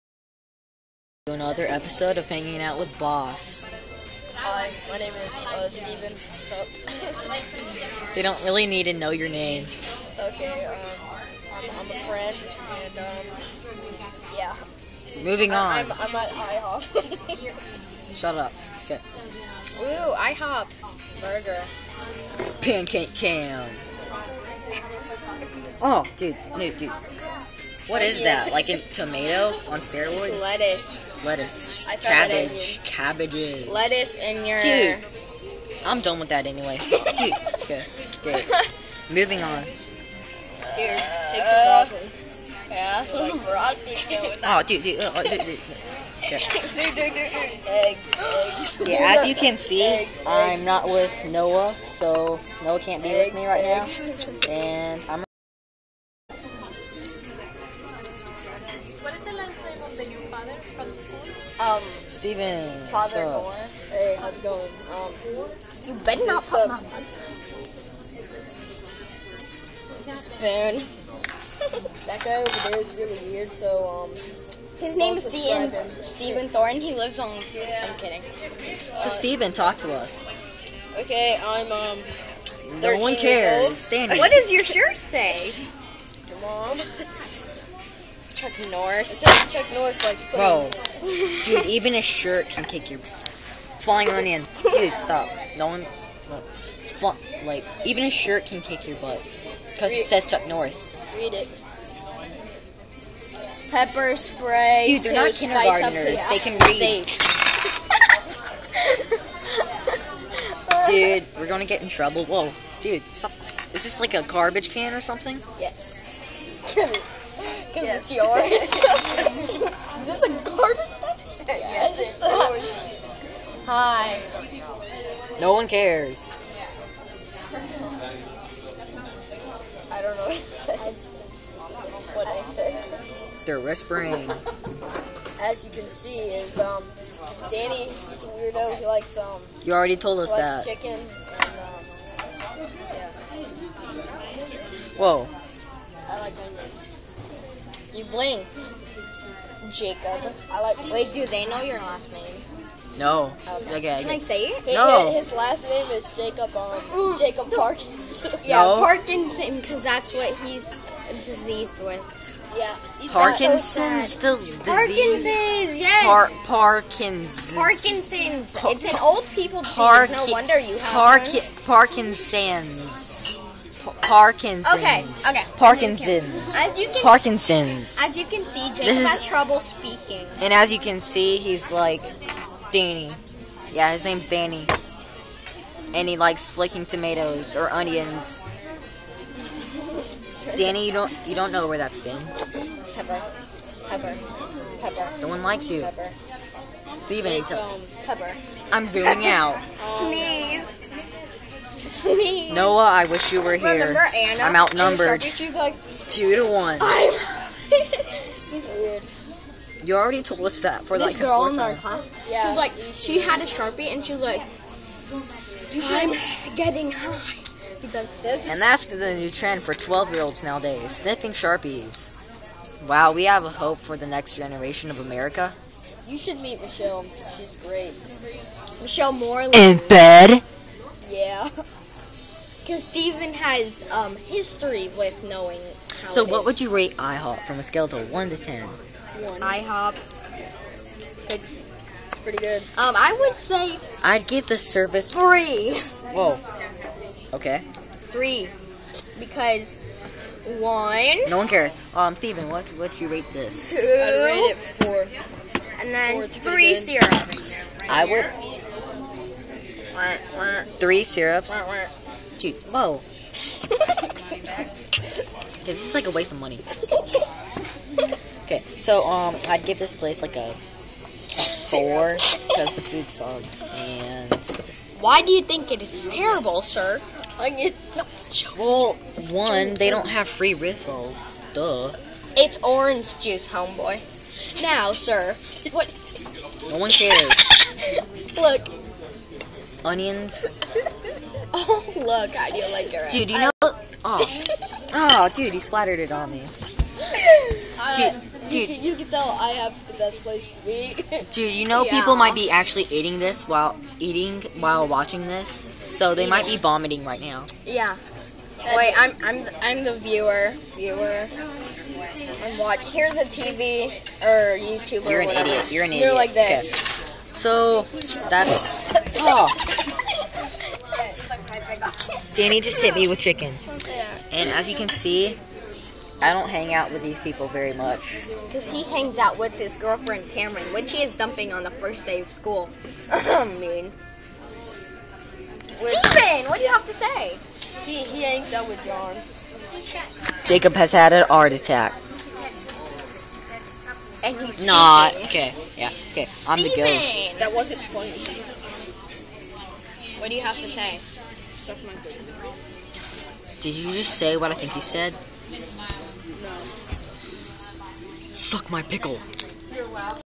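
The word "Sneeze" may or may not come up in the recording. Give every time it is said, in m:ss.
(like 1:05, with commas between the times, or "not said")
3:19.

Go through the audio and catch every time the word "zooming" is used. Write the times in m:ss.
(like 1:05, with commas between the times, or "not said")
3:18.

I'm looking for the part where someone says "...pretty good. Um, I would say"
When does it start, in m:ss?
4:02.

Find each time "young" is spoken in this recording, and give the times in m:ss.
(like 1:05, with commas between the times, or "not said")
not said.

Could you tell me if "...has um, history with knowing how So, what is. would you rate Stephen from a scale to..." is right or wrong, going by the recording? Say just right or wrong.
wrong.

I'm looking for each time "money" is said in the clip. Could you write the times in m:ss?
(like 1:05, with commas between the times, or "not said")
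4:26.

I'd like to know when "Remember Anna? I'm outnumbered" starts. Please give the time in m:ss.
3:23.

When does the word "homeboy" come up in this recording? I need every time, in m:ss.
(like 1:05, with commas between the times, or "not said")
4:43.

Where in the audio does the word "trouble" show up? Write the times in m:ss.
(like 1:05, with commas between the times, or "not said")
1:51, 2:59.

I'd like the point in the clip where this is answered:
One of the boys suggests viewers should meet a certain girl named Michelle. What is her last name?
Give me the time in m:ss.
3:49.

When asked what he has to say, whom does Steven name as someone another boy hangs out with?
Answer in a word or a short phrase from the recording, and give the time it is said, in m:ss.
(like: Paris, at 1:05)
John, at 5:38.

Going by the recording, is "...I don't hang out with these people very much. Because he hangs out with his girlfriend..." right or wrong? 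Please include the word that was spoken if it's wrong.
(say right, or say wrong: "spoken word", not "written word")
right.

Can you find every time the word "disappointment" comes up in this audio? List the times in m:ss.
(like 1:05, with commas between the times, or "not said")
not said.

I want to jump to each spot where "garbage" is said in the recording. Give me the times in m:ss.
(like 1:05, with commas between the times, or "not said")
1:54, 2:00.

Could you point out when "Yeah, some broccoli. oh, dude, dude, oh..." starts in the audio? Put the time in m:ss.
0:42.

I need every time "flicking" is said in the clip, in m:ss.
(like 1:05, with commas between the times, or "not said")
3:06.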